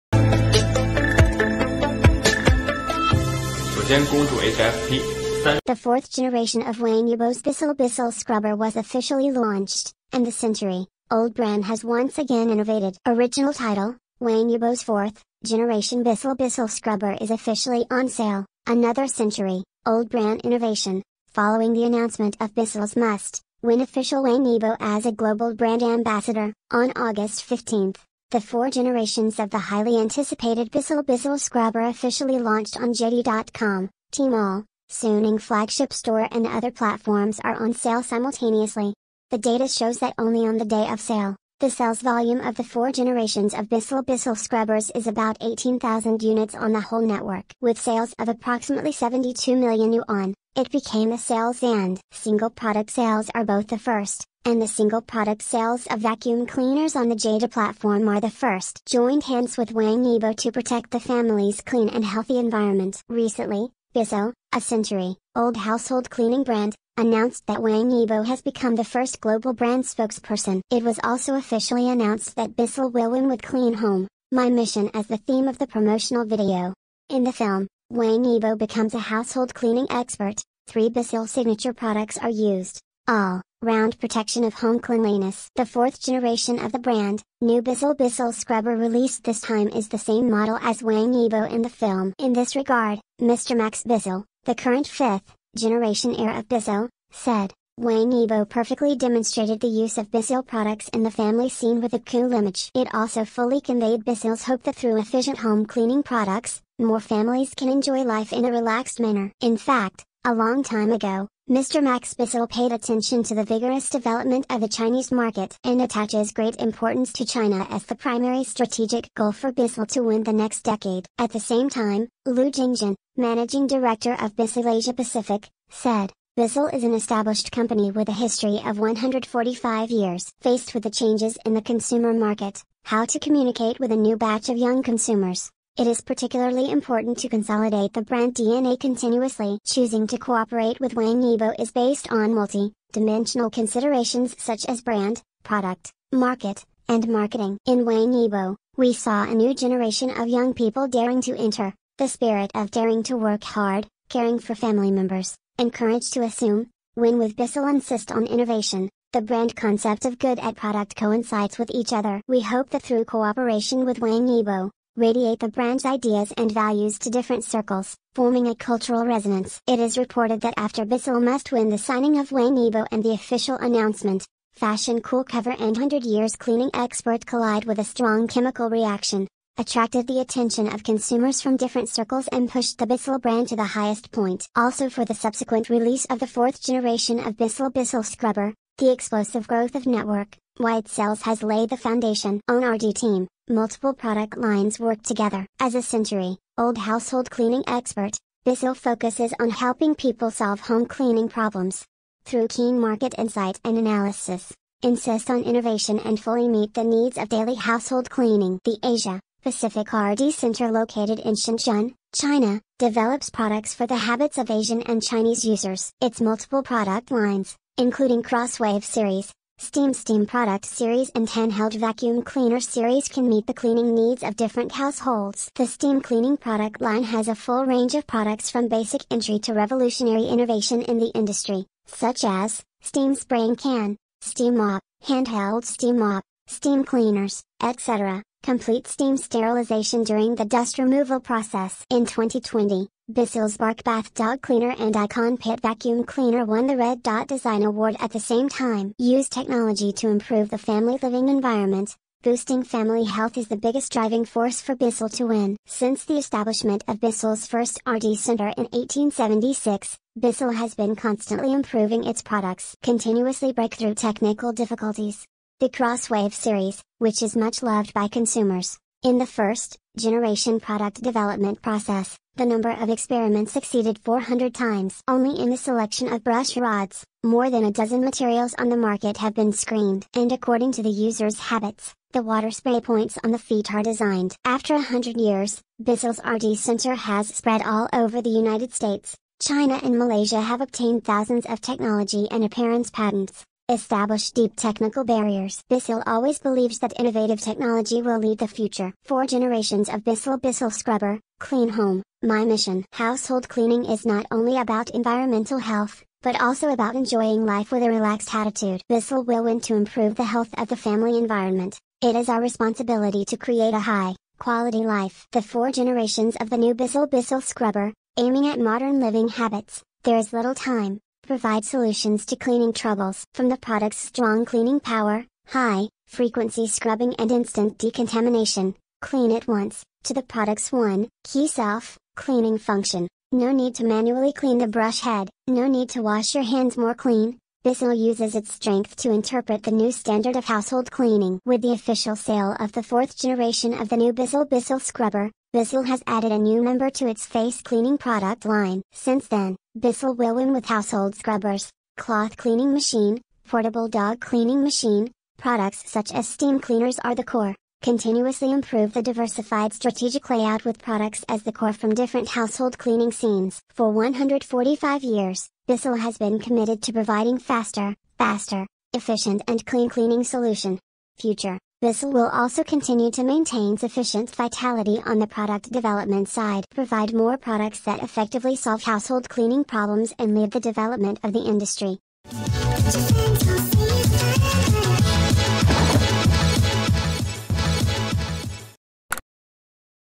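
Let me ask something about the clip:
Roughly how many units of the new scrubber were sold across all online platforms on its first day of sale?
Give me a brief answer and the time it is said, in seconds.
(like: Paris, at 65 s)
18,000, at 45 s.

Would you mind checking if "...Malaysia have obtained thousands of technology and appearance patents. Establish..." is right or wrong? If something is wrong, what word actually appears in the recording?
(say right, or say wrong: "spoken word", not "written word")
right.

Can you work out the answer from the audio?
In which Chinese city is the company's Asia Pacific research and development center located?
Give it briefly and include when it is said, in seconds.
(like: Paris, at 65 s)
Shenzhen, at 211 s.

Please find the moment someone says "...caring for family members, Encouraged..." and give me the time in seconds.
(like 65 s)
154 s.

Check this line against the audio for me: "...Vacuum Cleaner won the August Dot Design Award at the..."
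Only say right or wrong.
wrong.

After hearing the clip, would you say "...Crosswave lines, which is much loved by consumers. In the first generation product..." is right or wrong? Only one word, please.
wrong.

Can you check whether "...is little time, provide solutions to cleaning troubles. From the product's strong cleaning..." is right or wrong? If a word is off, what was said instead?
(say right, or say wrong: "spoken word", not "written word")
right.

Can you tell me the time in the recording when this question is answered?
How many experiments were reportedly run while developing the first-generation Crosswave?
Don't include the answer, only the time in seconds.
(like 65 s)
273 s.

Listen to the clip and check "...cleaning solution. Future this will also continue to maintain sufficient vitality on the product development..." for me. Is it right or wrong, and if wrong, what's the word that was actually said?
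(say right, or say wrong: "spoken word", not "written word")
right.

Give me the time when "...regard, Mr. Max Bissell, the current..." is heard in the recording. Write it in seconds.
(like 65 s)
92 s.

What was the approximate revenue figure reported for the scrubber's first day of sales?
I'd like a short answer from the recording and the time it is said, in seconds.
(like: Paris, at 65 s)
72 million yuan, at 48 s.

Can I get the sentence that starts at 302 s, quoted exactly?
Household cleaning is not only about environmental health, but also about enjoying life with a relaxed attitude.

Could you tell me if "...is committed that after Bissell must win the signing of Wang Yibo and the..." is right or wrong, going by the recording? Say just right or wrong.
wrong.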